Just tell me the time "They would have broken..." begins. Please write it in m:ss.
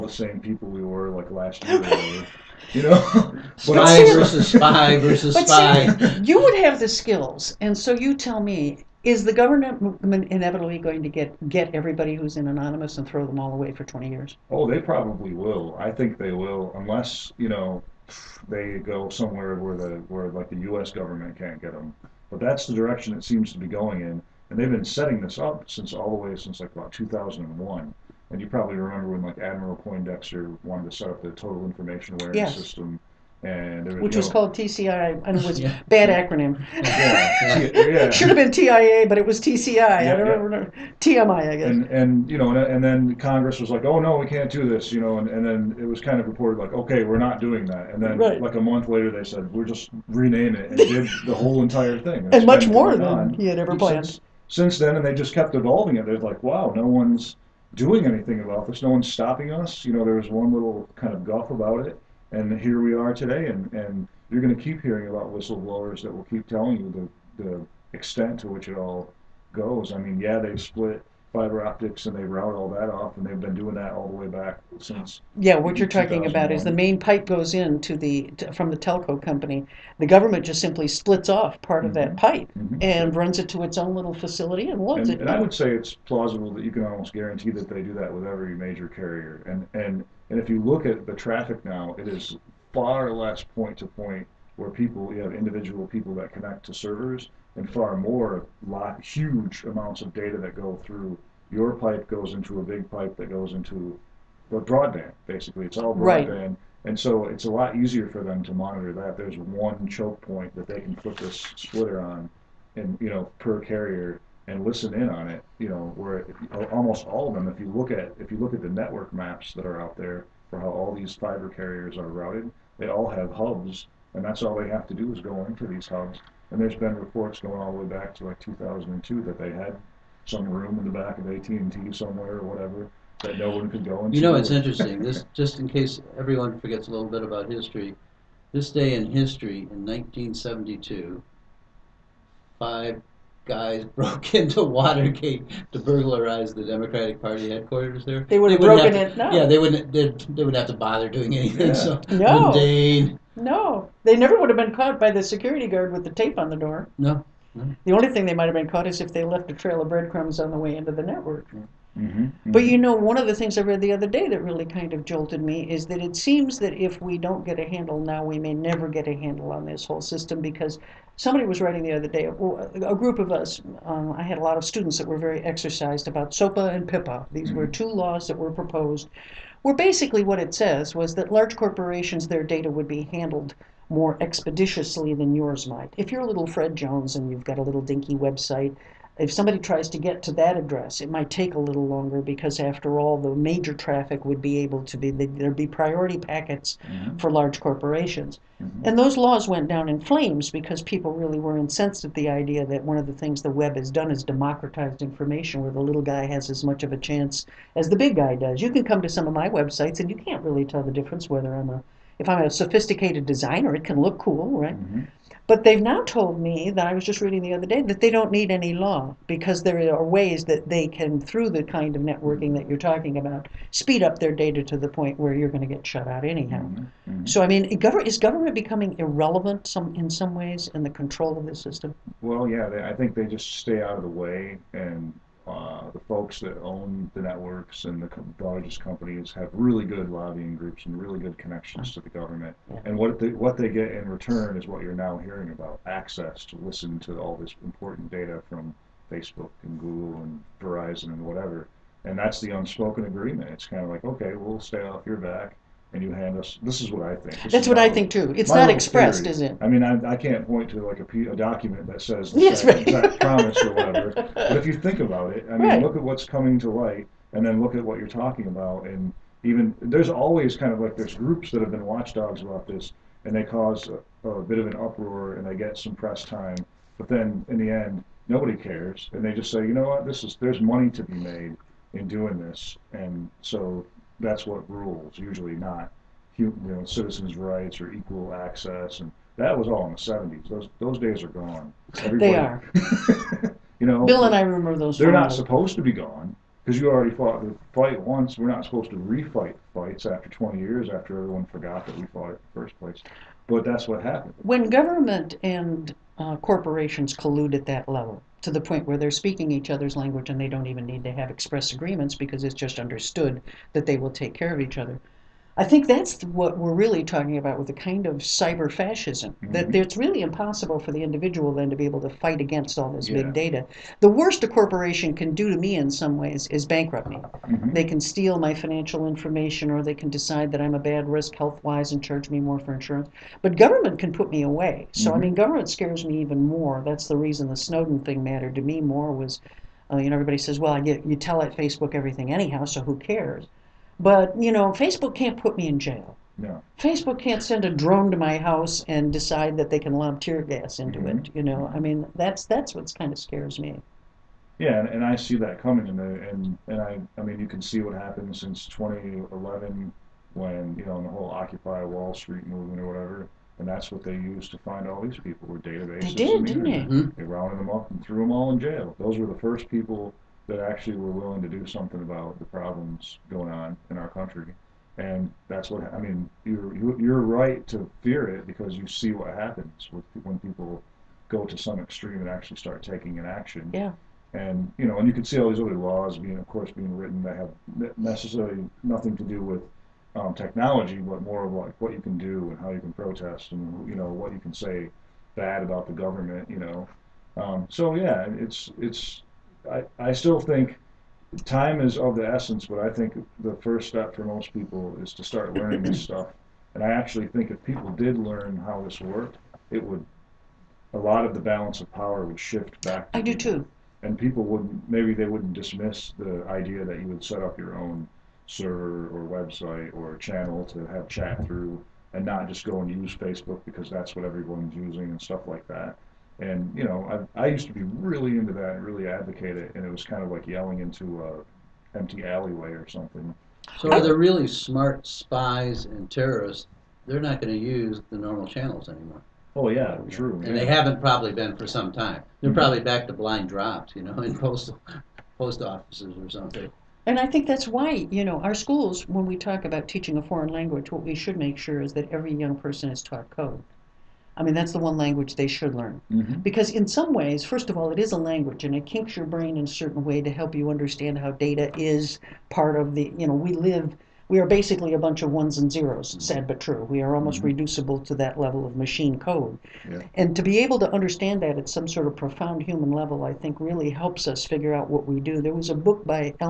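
2:28.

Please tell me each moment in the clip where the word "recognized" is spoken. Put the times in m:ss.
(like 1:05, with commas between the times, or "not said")
not said.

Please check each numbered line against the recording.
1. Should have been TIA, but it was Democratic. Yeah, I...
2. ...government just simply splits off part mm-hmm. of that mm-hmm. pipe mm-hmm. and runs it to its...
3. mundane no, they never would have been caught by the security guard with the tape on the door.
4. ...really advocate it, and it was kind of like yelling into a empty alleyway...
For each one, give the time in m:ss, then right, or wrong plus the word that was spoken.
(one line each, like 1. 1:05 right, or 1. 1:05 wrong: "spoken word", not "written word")
1. 0:38 wrong: "TCI", not "Democratic"
2. 1:20 right
3. 2:32 right
4. 7:08 right.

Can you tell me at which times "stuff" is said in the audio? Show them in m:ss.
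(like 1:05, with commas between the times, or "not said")
6:46, 7:05.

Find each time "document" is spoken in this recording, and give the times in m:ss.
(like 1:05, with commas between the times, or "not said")
4:21.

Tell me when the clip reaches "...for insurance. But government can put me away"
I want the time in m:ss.
5:32.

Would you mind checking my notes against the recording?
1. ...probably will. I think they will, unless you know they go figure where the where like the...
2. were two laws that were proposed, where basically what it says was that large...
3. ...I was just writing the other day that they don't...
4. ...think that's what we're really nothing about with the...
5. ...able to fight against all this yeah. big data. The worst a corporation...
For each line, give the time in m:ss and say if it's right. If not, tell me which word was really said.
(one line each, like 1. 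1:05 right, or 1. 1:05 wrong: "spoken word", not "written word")
1. 0:14 wrong: "somewhere", not "figure"
2. 2:57 right
3. 3:36 wrong: "reading", not "writing"
4. 5:15 wrong: "talking", not "nothing"
5. 5:21 right.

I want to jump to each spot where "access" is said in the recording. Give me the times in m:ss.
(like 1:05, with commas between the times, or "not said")
4:05, 4:48.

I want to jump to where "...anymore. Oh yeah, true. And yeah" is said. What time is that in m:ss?
7:18.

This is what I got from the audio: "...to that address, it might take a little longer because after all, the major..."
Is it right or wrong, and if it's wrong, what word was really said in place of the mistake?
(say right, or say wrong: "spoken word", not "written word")
right.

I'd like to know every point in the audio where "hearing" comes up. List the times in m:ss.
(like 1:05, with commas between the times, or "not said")
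1:04, 4:05.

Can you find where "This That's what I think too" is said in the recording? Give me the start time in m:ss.
4:17.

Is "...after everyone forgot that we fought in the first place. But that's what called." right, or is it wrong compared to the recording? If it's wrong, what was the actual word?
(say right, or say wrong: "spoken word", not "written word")
wrong: "happened", not "called".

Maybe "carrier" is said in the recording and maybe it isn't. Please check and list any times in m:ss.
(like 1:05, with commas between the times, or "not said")
1:28, 1:53, 2:01.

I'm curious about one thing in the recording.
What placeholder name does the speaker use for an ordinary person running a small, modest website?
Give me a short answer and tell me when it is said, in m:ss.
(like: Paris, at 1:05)
Fred Jones, at 3:06.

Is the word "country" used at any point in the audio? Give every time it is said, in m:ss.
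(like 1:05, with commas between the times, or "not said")
6:14.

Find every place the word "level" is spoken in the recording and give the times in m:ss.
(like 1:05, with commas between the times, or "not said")
5:07, 7:48, 7:52.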